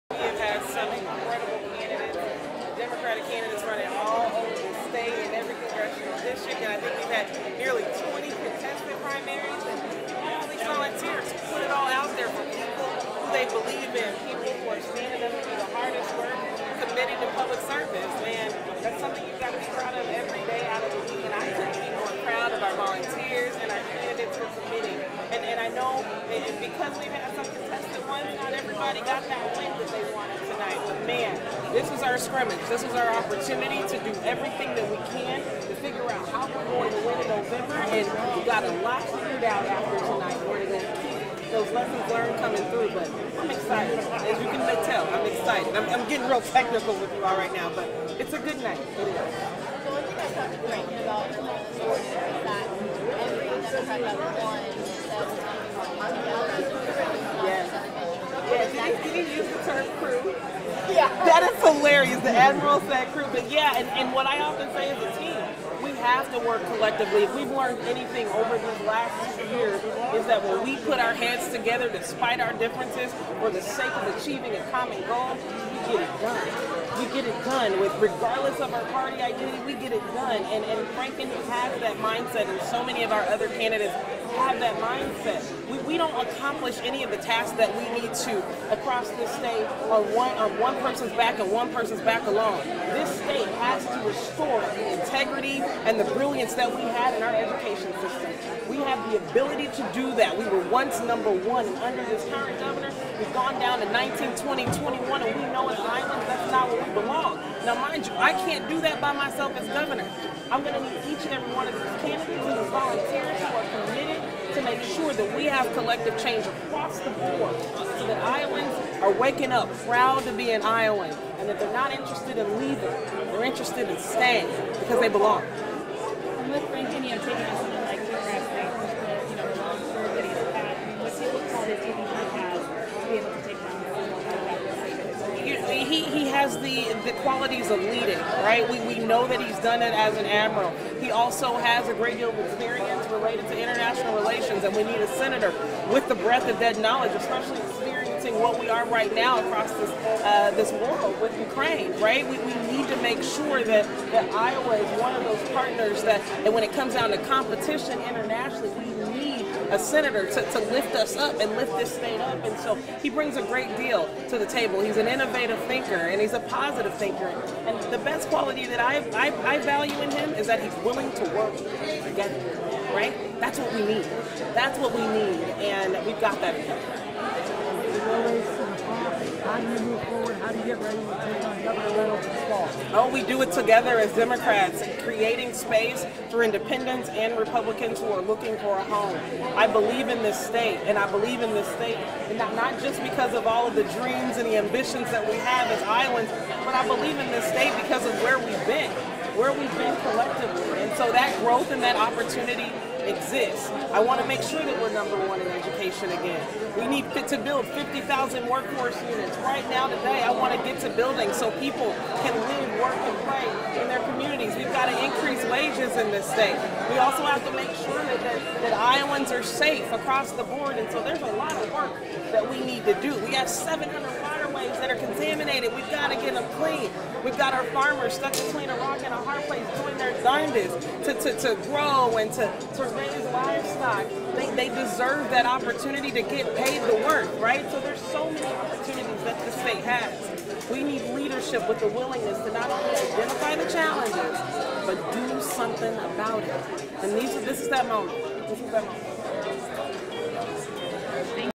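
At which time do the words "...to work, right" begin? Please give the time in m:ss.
3:56.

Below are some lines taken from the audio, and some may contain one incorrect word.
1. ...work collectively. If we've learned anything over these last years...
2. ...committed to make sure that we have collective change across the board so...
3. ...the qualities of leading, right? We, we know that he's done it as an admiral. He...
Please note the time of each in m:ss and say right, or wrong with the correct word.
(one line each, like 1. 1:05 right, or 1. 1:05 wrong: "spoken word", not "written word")
1. 1:06 right
2. 1:53 right
3. 2:17 right.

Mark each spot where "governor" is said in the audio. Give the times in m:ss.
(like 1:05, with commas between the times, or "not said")
1:42, 1:49, 3:01.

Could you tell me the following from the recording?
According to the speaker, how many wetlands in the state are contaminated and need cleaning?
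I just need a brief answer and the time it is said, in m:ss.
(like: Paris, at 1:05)
700, at 3:43.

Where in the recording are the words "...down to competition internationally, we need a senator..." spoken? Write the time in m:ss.
2:36.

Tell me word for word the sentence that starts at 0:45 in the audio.
I'm, I'm getting real technical with you all right now, but it's a good night.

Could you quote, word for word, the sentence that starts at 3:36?
We also have to make sure that, that, that Iowans are safe across the board.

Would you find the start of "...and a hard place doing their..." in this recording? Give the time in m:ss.
3:49.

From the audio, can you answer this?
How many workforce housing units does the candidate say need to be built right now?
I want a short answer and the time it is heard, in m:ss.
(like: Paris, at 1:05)
50,000, at 3:27.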